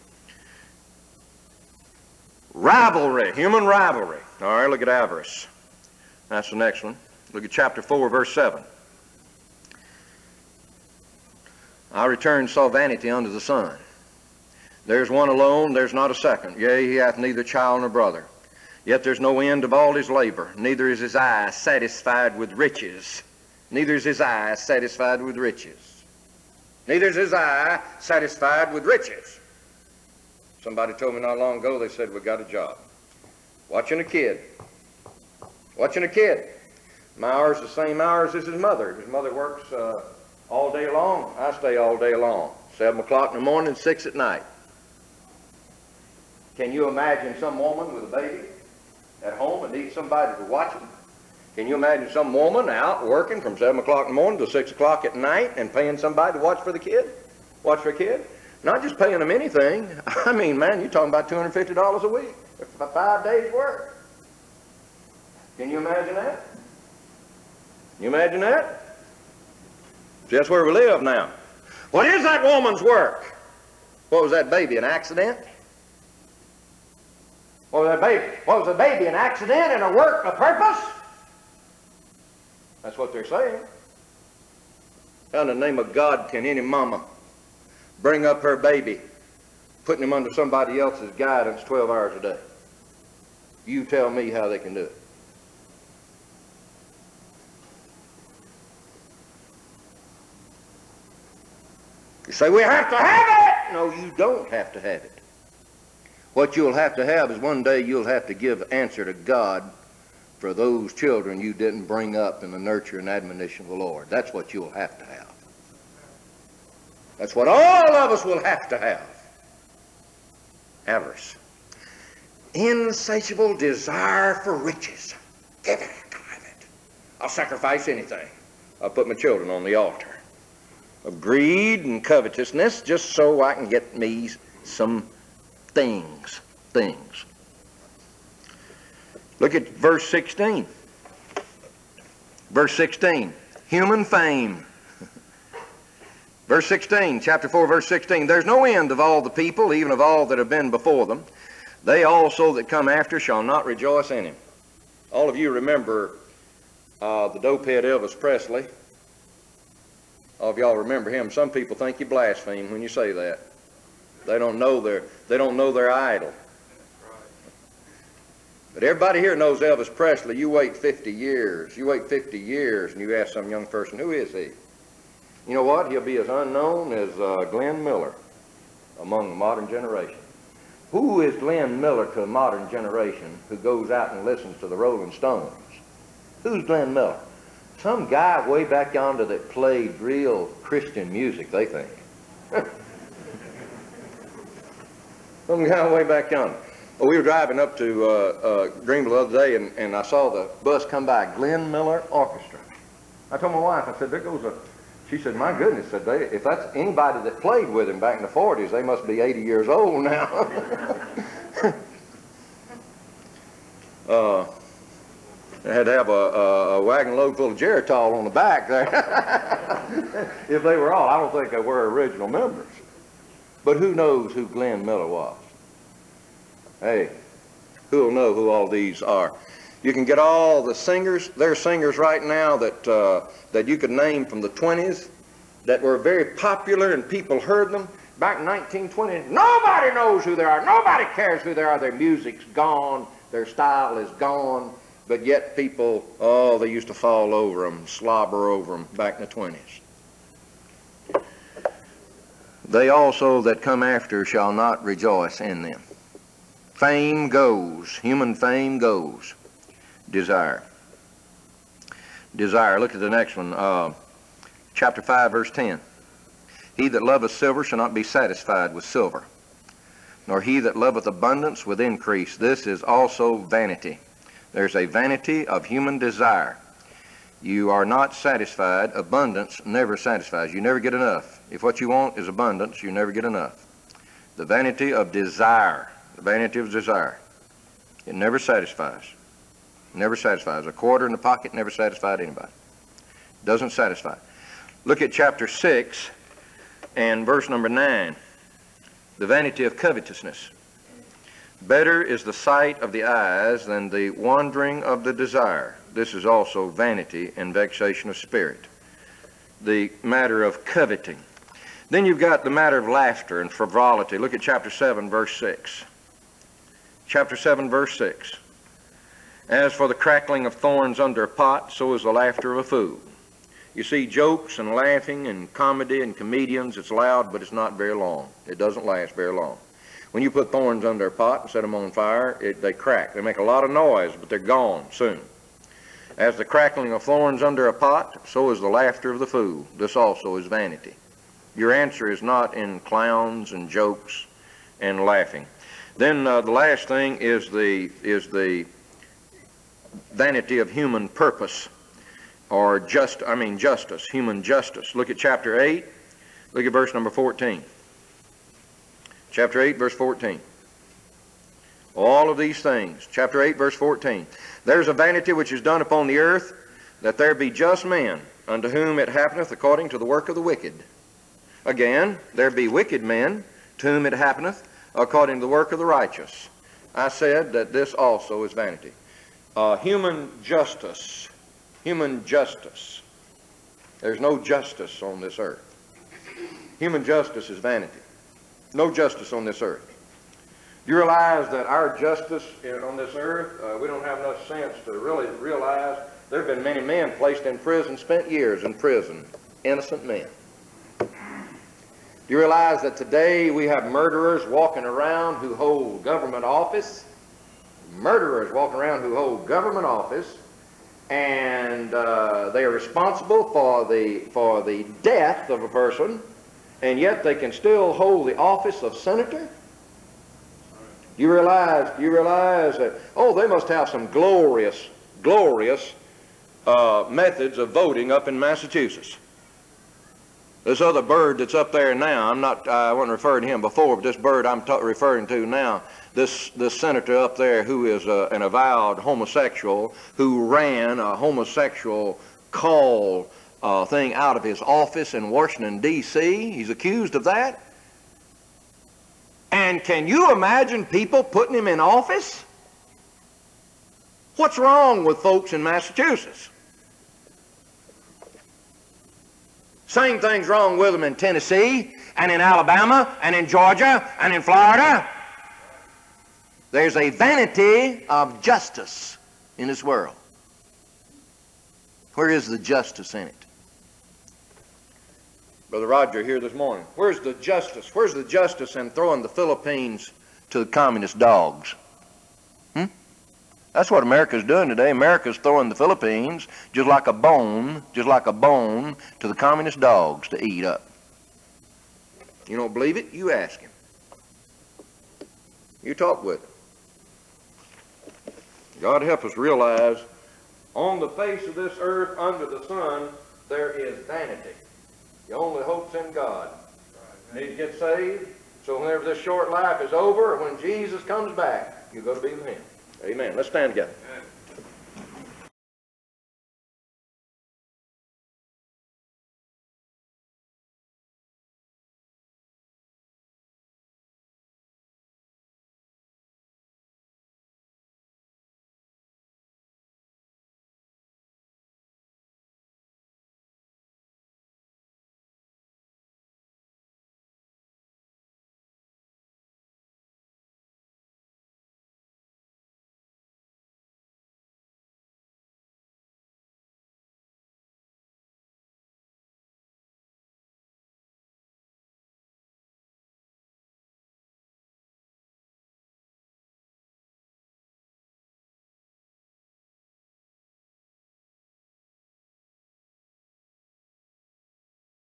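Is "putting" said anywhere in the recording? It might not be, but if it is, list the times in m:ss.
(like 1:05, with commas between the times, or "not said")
1:29, 7:31.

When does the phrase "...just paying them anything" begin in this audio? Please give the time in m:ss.
0:58.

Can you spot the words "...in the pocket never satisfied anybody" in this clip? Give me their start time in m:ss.
4:51.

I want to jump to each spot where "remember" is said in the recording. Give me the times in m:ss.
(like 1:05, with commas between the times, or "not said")
2:35, 2:40.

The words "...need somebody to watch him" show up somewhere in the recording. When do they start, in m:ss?
0:49.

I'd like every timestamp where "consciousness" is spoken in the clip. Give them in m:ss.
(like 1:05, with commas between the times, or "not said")
not said.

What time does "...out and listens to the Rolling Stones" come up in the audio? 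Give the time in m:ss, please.
3:03.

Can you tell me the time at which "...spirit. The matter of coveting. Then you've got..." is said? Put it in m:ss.
5:08.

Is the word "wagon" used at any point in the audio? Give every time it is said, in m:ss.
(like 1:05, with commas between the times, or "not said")
3:36.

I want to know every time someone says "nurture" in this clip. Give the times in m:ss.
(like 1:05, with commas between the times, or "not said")
1:52.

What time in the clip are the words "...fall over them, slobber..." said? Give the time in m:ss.
4:06.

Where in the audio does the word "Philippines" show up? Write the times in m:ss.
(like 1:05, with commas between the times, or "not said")
7:59, 8:05.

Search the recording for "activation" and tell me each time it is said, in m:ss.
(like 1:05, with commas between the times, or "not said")
not said.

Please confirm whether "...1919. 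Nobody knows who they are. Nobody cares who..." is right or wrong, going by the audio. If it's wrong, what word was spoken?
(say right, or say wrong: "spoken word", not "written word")
wrong: "1920", not "1919".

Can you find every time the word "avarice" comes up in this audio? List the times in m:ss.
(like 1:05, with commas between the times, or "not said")
0:04, 2:00.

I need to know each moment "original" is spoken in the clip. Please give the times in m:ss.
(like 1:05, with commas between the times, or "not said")
3:41.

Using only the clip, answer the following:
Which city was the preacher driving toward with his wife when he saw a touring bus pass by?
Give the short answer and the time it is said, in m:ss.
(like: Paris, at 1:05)
Greenville, at 3:18.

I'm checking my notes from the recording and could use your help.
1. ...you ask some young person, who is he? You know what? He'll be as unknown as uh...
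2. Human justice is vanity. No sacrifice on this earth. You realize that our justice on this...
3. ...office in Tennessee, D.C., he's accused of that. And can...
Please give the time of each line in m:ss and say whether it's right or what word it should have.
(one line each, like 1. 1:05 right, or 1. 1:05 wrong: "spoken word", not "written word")
1. 2:52 right
2. 6:26 wrong: "justice", not "sacrifice"
3. 7:24 wrong: "Washington", not "Tennessee".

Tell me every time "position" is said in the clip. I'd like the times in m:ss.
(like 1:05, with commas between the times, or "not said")
not said.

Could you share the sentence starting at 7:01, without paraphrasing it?
You realize you realize that oh they must have some glorious glorious uh, methods of voting up in Massachusetts.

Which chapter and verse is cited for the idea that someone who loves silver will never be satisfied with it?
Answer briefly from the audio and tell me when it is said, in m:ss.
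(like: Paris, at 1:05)
Chapter 5, verse 10, at 4:24.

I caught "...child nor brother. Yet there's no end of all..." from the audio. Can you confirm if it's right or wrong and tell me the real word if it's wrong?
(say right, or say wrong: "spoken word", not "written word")
right.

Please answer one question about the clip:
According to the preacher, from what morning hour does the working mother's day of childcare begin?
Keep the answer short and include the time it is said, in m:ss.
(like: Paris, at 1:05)
7 o'clock, at 0:42.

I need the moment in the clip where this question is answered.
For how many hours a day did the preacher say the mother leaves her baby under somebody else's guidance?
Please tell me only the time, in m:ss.
1:31.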